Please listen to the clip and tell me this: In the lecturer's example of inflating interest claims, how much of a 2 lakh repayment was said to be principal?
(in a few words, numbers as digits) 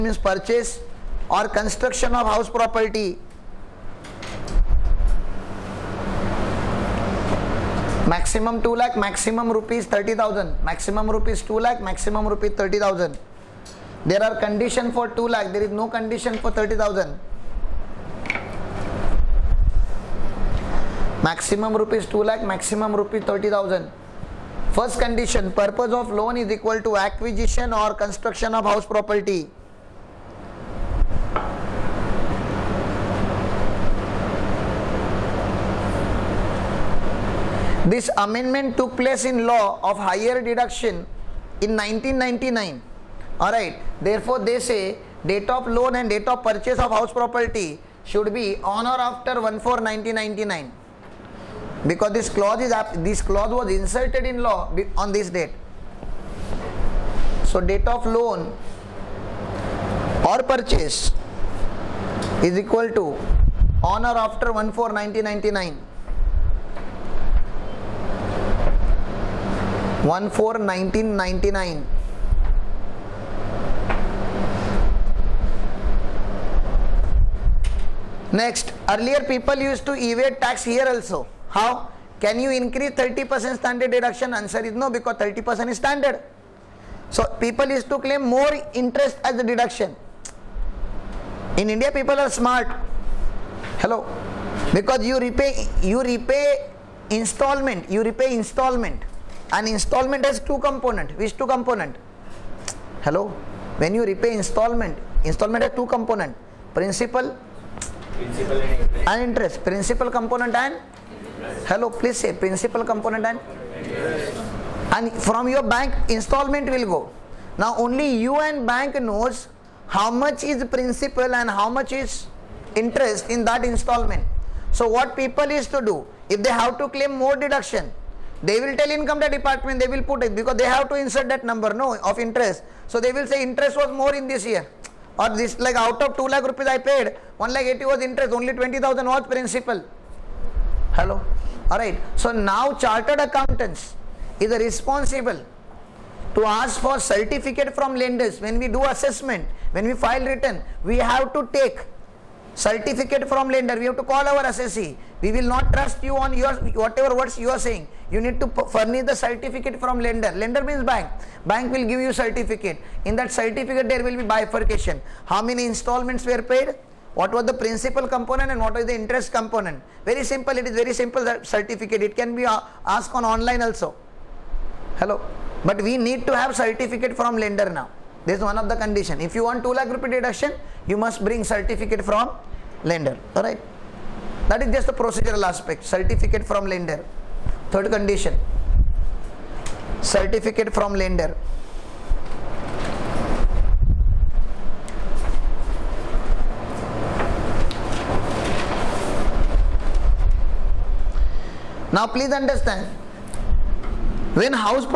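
20000.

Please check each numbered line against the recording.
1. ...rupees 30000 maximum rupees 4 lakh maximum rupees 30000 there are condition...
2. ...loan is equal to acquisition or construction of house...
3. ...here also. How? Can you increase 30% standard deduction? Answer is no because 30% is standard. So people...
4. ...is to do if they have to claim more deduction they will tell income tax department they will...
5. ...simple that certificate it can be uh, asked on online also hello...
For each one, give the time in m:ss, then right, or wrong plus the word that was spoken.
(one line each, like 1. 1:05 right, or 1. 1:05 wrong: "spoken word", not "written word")
1. 0:09 wrong: "2", not "4"
2. 0:26 right
3. 1:20 right
4. 2:05 right
5. 2:50 right.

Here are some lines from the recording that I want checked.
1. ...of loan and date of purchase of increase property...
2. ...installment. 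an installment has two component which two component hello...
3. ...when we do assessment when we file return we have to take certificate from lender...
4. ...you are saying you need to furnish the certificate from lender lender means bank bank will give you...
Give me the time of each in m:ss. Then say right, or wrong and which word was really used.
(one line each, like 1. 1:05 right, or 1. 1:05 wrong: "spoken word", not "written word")
1. 0:45 wrong: "house", not "increase"
2. 1:38 right
3. 2:28 right
4. 2:37 right.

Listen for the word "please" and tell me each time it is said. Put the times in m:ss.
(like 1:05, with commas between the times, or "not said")
1:51, 3:22.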